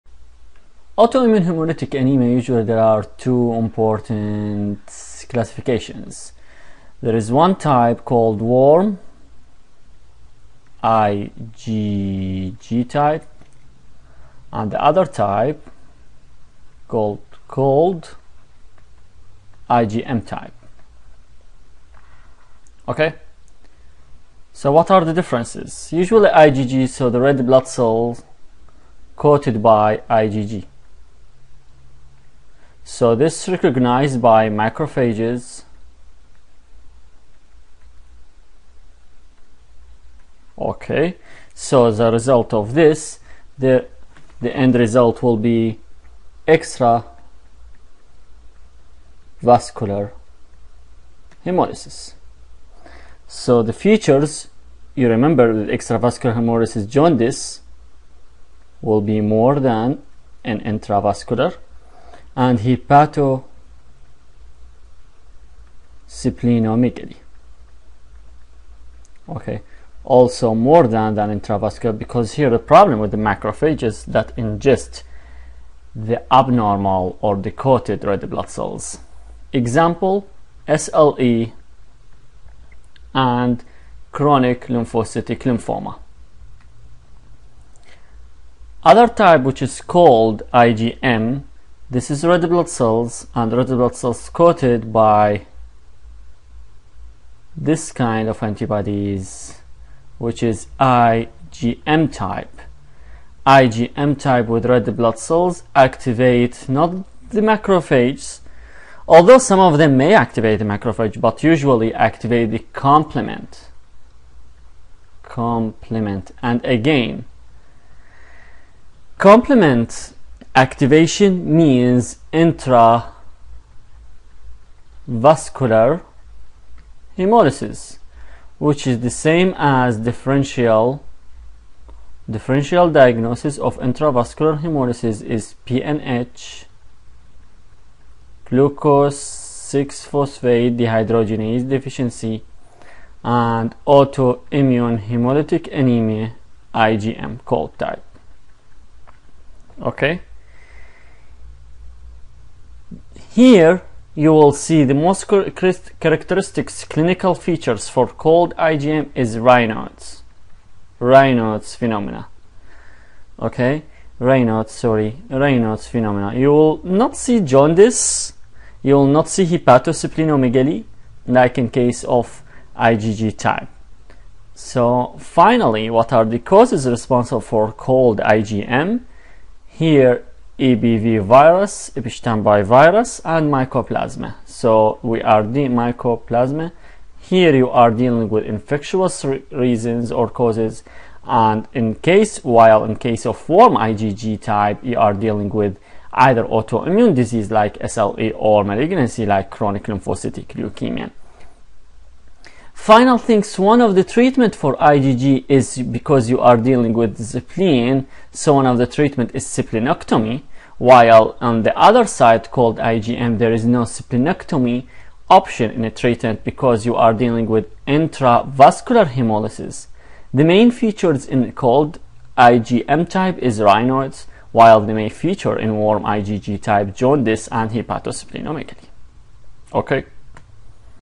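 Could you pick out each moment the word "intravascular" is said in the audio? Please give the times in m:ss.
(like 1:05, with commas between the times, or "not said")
1:00, 1:11, 2:02, 2:13, 3:37.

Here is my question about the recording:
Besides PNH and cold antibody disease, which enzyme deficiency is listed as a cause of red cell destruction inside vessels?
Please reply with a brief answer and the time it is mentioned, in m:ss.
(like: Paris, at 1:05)
Glucose 6 phosphate dehydrogenase deficiency, at 2:18.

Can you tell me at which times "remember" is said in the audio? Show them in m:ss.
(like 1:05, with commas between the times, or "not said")
0:55.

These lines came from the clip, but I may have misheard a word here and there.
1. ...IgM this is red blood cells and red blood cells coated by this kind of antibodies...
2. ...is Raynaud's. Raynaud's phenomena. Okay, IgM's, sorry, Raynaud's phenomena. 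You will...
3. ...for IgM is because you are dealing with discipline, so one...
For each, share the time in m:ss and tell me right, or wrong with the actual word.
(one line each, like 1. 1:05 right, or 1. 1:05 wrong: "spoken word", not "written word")
1. 1:30 right
2. 2:39 wrong: "Raynaud", not "IgM"
3. 3:24 wrong: "IgG", not "IgM".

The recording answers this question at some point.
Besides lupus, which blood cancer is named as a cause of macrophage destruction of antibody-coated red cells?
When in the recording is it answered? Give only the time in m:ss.
1:24.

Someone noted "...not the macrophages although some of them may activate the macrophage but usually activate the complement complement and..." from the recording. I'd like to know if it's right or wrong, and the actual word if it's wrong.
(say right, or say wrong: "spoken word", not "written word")
right.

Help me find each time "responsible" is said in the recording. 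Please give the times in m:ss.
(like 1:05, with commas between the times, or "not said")
2:56.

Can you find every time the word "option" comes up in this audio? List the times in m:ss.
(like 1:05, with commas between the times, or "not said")
3:35.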